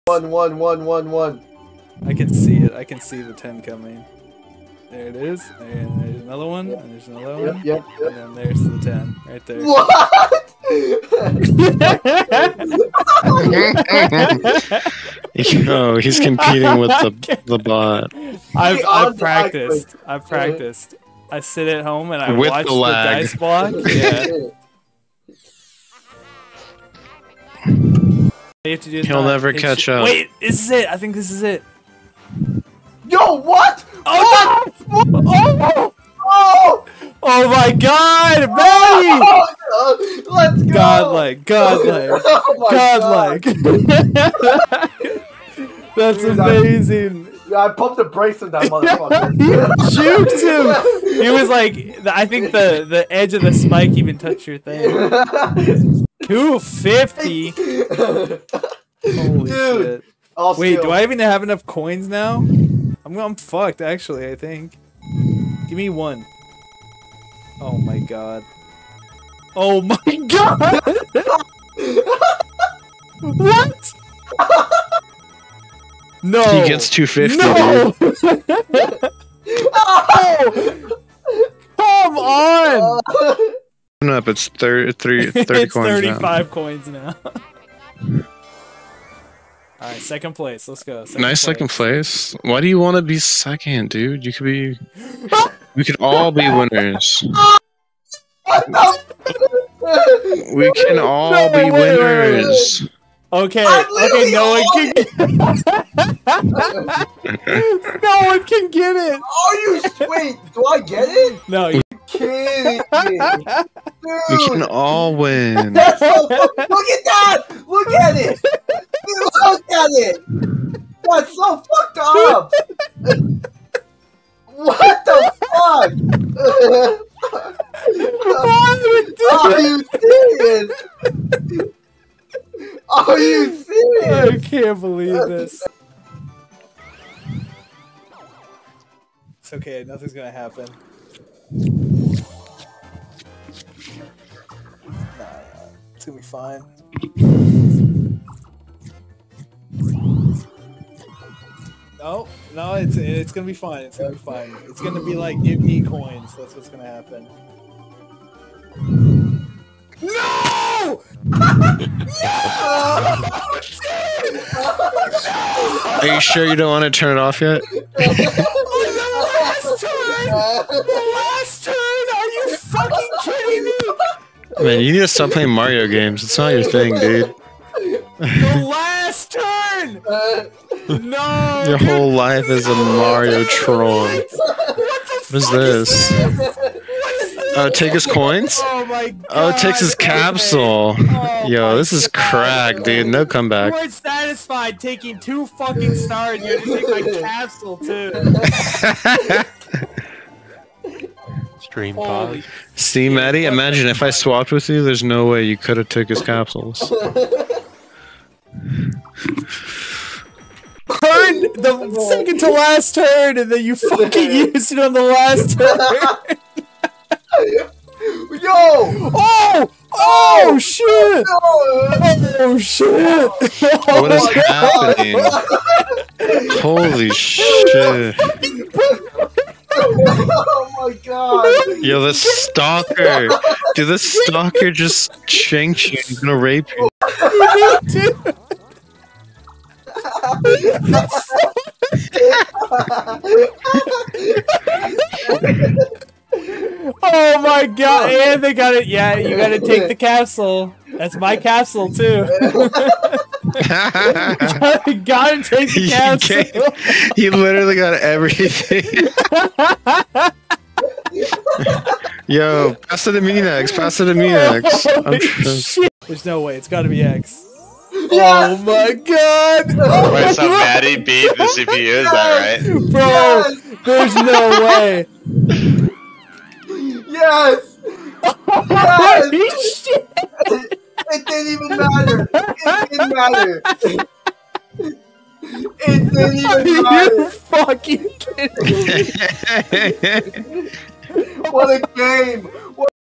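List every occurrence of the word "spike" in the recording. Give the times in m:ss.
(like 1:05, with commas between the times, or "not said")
0:53.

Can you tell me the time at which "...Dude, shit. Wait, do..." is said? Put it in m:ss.
0:59.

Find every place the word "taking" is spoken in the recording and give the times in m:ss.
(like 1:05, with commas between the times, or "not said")
3:14.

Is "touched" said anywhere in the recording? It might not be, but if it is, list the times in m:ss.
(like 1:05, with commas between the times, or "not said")
0:54.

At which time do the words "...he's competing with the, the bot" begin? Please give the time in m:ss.
0:16.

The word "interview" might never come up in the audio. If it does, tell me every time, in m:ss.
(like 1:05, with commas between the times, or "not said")
not said.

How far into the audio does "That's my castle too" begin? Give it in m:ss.
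4:10.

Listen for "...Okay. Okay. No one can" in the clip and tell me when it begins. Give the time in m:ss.
1:43.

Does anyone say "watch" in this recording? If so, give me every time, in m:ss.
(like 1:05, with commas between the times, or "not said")
0:22.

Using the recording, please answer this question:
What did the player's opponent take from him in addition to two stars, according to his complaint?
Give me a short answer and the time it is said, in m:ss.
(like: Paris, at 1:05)
His capsule, at 3:16.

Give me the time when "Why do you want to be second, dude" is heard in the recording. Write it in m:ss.
1:32.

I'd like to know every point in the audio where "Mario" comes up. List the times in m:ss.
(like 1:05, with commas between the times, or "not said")
2:55, 3:02.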